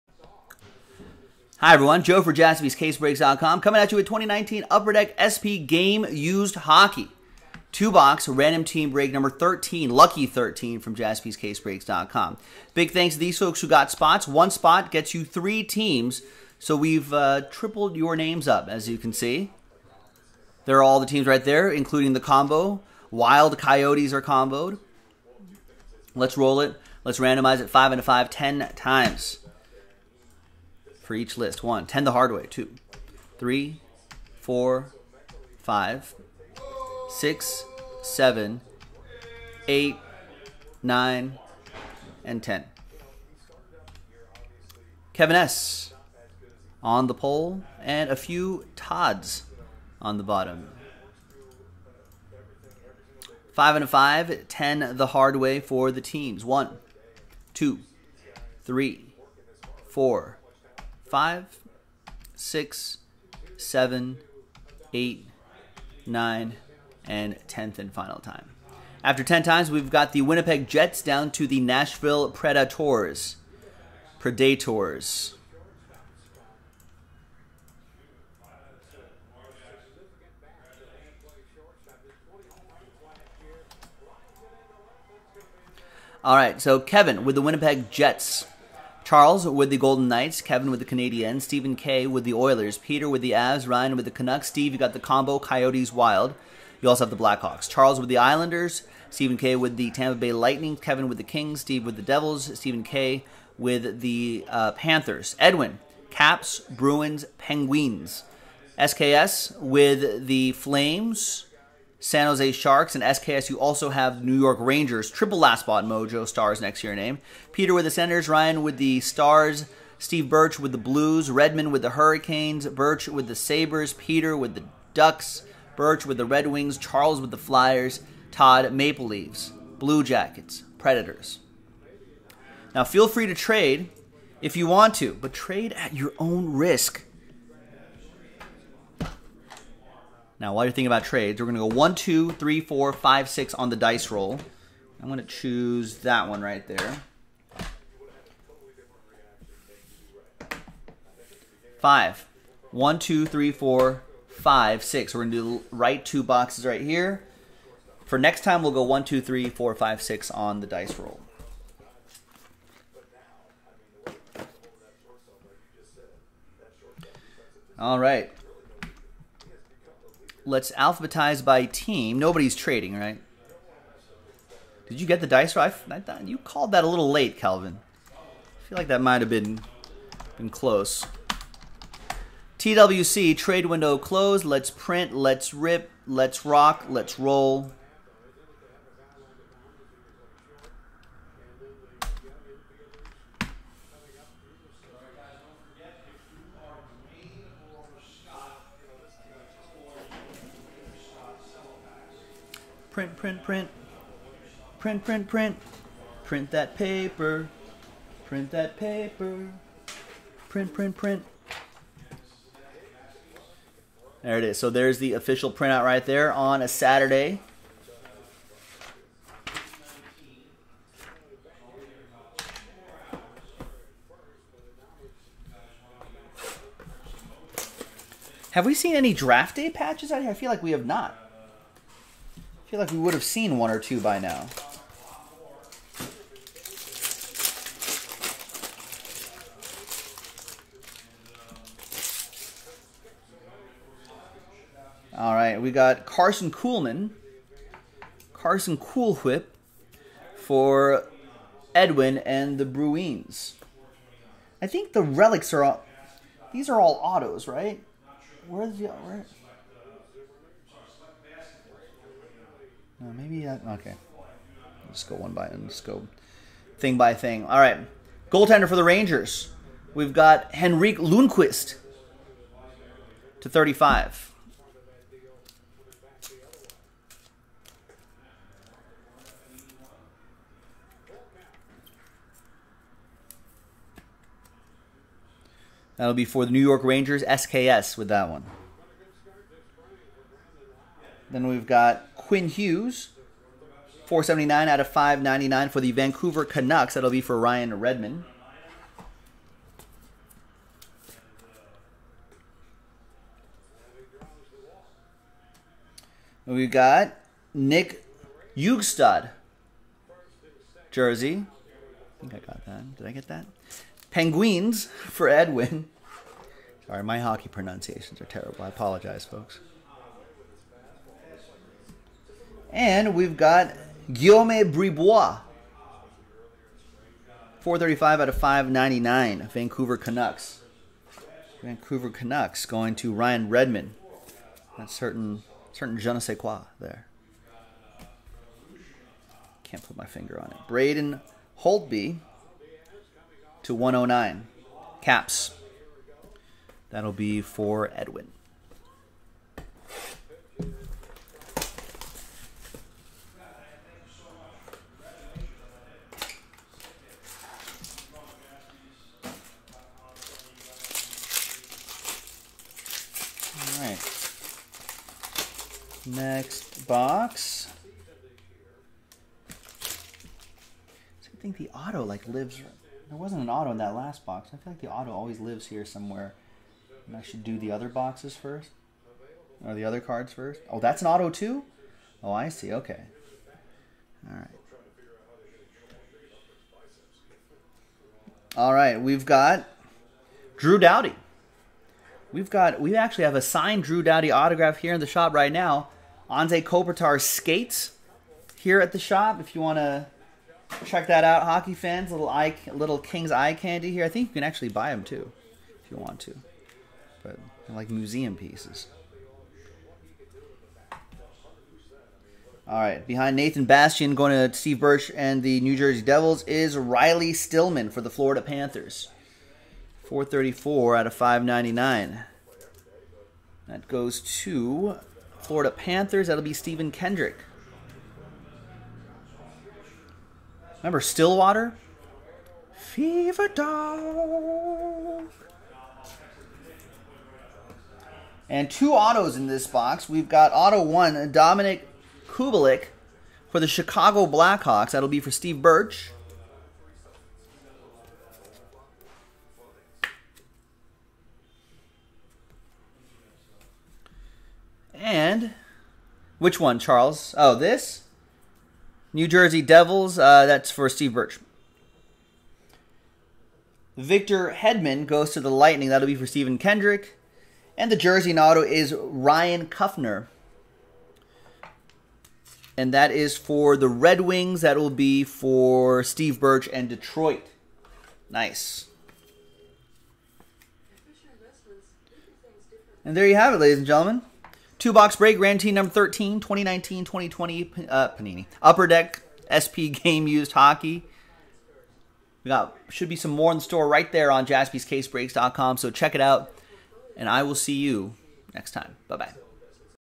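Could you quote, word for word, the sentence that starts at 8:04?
Two box break, Grand Team number 13, 2019 2020 uh, Panini.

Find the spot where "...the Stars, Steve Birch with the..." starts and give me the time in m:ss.
1:58.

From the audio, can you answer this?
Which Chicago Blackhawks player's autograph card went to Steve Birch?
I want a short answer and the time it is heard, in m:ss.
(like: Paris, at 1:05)
Dominik Kubalik, at 7:21.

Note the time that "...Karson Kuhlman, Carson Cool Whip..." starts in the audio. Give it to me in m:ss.
4:06.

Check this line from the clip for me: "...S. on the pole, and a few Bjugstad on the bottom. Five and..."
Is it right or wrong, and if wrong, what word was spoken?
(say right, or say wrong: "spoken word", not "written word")
wrong: "Todds", not "Bjugstad".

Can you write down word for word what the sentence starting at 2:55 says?
I thought you called that a little late, Calvin.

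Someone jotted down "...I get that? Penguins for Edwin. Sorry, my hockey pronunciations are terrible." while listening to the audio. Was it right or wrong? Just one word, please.
right.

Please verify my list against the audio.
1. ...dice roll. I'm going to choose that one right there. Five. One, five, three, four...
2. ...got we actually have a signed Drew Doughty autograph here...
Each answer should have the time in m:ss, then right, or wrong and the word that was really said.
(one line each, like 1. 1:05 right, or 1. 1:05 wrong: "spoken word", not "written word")
1. 2:23 wrong: "two", not "five"
2. 6:32 right.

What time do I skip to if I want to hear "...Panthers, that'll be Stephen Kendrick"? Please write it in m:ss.
7:05.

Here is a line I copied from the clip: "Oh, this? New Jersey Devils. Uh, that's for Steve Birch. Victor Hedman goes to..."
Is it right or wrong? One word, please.
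right.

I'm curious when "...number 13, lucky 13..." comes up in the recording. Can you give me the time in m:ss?
0:09.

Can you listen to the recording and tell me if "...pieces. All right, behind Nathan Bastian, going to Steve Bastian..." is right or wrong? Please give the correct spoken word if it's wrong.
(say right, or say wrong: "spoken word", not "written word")
wrong: "Birch", not "Bastian".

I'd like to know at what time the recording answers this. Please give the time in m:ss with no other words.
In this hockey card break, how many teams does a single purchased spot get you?
0:15.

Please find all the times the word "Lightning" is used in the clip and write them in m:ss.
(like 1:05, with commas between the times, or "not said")
1:40, 7:45.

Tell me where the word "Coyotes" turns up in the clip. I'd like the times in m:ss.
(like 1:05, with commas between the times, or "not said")
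0:23, 1:35.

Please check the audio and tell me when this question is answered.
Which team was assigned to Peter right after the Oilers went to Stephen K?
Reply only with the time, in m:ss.
1:33.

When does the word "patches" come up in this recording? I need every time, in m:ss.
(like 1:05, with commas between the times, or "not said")
3:49.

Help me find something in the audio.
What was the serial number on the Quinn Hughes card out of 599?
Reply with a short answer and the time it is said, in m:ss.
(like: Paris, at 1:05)
479, at 4:54.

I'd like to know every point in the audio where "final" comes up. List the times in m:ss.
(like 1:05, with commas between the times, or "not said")
1:07.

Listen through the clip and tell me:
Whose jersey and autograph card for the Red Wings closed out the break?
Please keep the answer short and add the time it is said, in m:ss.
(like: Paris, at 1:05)
Ryan Kuffner, at 7:48.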